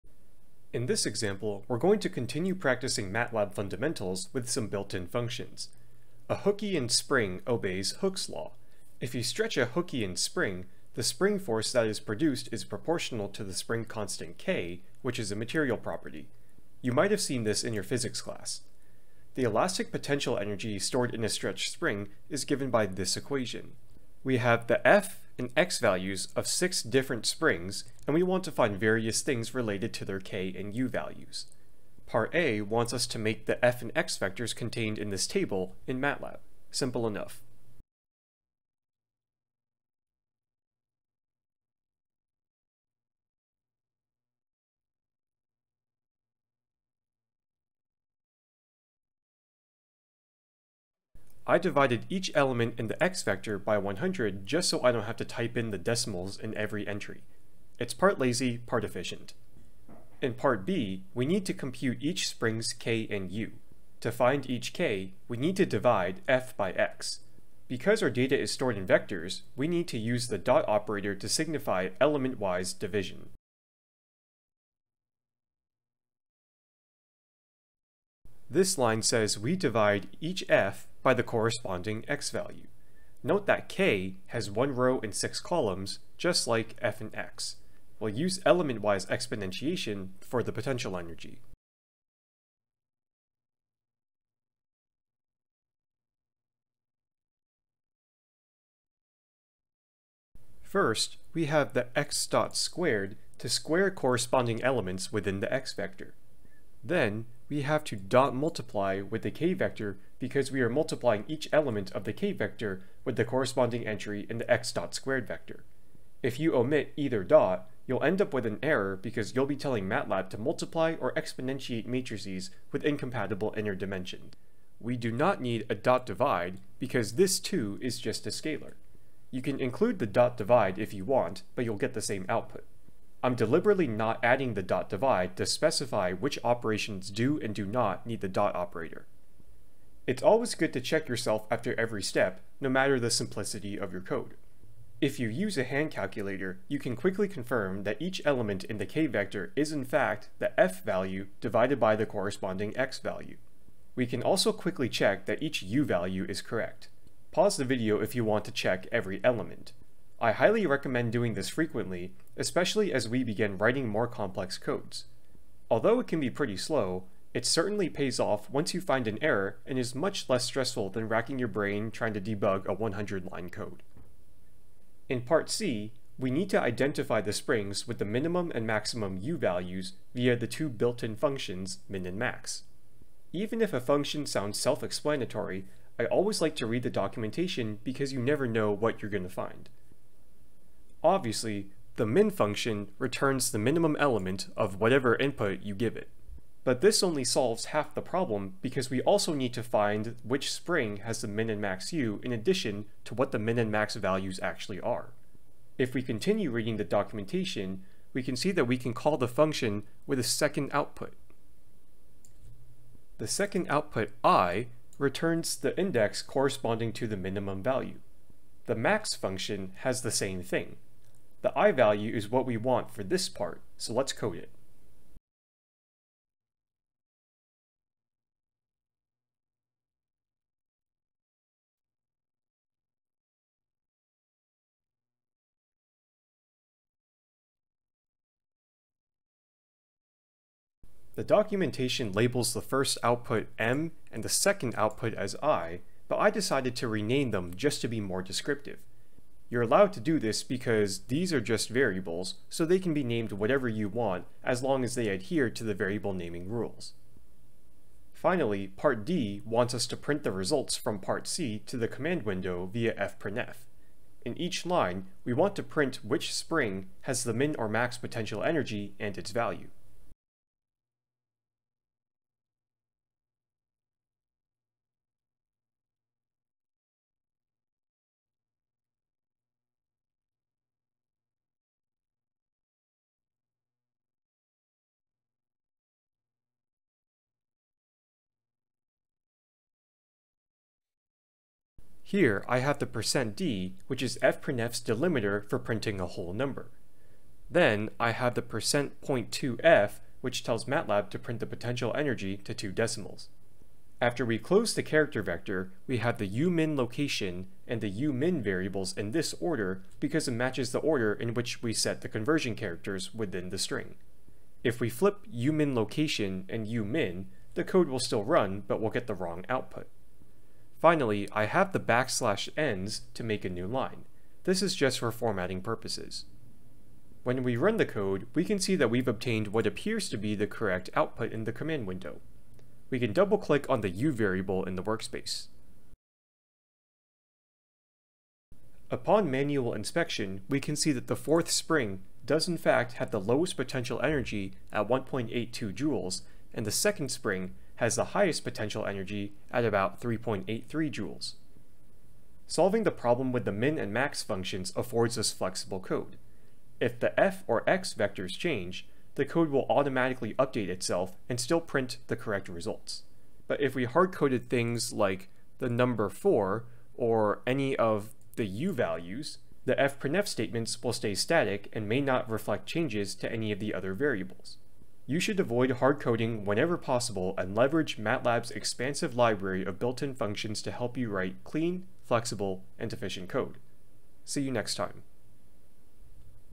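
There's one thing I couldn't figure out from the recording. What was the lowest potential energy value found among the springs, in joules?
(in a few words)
1.82 joules.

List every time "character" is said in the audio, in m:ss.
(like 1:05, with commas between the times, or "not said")
5:04, 5:12.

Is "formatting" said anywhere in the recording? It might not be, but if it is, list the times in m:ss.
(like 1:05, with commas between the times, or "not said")
5:25.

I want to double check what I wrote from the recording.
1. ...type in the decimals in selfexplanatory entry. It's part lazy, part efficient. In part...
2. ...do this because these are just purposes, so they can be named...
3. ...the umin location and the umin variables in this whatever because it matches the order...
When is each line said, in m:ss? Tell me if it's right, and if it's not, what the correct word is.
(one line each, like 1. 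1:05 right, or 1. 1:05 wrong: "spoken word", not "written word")
1. 0:55 wrong: "every", not "selfexplanatory"
2. 4:09 wrong: "variables", not "purposes"
3. 5:06 wrong: "order", not "whatever".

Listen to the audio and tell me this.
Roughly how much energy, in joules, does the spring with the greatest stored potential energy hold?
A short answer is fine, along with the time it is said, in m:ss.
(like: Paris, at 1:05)
3.83 joules, at 5:49.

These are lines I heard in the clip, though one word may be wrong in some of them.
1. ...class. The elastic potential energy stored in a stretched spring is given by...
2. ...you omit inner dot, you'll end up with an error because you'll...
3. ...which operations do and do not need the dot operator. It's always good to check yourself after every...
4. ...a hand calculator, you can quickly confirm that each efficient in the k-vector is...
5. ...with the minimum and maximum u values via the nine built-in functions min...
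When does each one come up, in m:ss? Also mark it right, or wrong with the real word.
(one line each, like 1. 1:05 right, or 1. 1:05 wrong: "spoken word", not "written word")
1. 0:18 right
2. 1:56 wrong: "either", not "inner"
3. 2:16 right
4. 2:25 wrong: "element", not "efficient"
5. 2:57 wrong: "two", not "nine".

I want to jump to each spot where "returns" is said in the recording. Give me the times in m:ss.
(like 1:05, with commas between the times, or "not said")
3:12, 3:34.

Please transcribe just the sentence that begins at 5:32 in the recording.
We can double-click on the u variable in the workspace.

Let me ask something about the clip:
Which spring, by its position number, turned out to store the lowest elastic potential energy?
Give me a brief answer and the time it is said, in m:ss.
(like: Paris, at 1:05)
4th, at 5:41.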